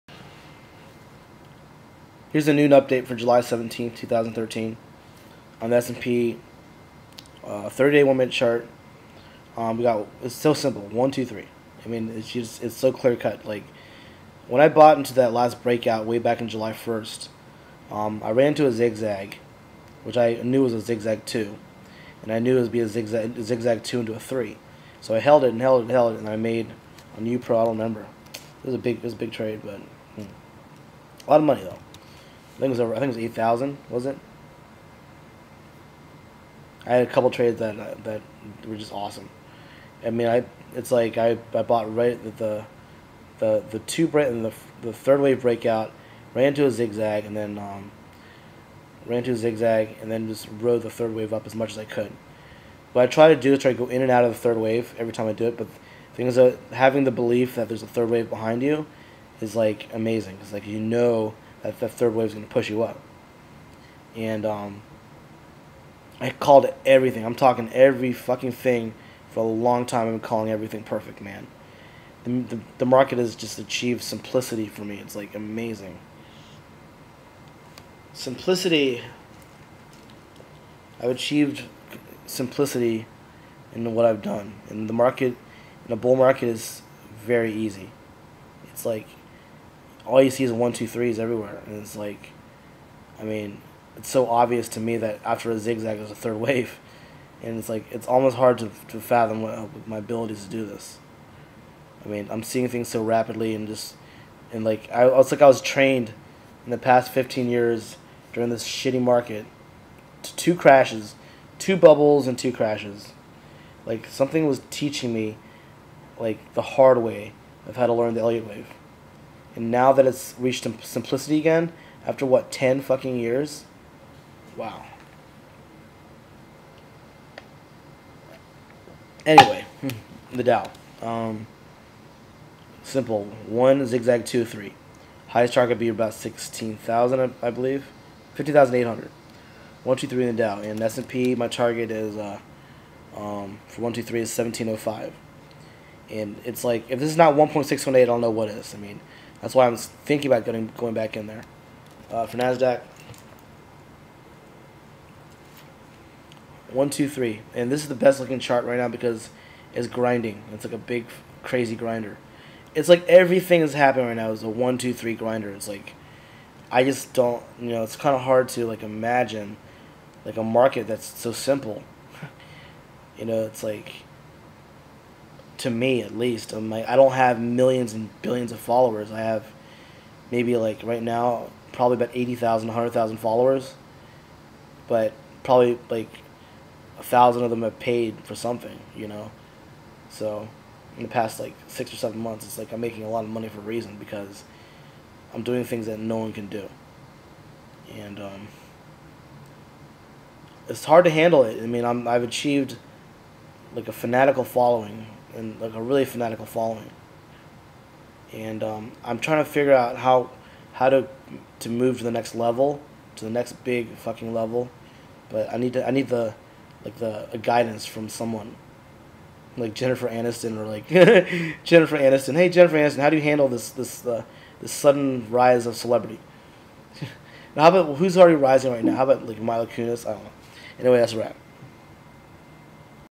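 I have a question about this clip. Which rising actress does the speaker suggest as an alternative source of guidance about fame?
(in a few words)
Mila Kunis.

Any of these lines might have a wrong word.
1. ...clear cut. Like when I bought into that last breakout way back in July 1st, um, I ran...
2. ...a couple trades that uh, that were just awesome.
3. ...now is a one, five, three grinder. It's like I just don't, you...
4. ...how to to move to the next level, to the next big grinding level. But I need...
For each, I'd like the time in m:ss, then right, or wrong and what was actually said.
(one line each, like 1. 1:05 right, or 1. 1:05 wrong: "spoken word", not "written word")
1. 0:12 right
2. 0:37 right
3. 2:44 wrong: "two", not "five"
4. 3:30 wrong: "fucking", not "grinding".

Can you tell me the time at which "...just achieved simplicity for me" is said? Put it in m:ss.
1:13.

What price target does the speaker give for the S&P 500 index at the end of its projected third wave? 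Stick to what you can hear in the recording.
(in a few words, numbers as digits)
1705.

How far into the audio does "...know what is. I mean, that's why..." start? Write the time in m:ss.
2:28.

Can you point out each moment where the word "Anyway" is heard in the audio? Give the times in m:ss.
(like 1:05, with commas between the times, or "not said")
2:09, 3:50.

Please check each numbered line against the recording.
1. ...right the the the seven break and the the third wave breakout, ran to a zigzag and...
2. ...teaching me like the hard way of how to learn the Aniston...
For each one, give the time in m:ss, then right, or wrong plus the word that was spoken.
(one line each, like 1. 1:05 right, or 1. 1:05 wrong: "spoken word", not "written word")
1. 0:41 wrong: "two", not "seven"
2. 1:54 wrong: "Elliott", not "Aniston".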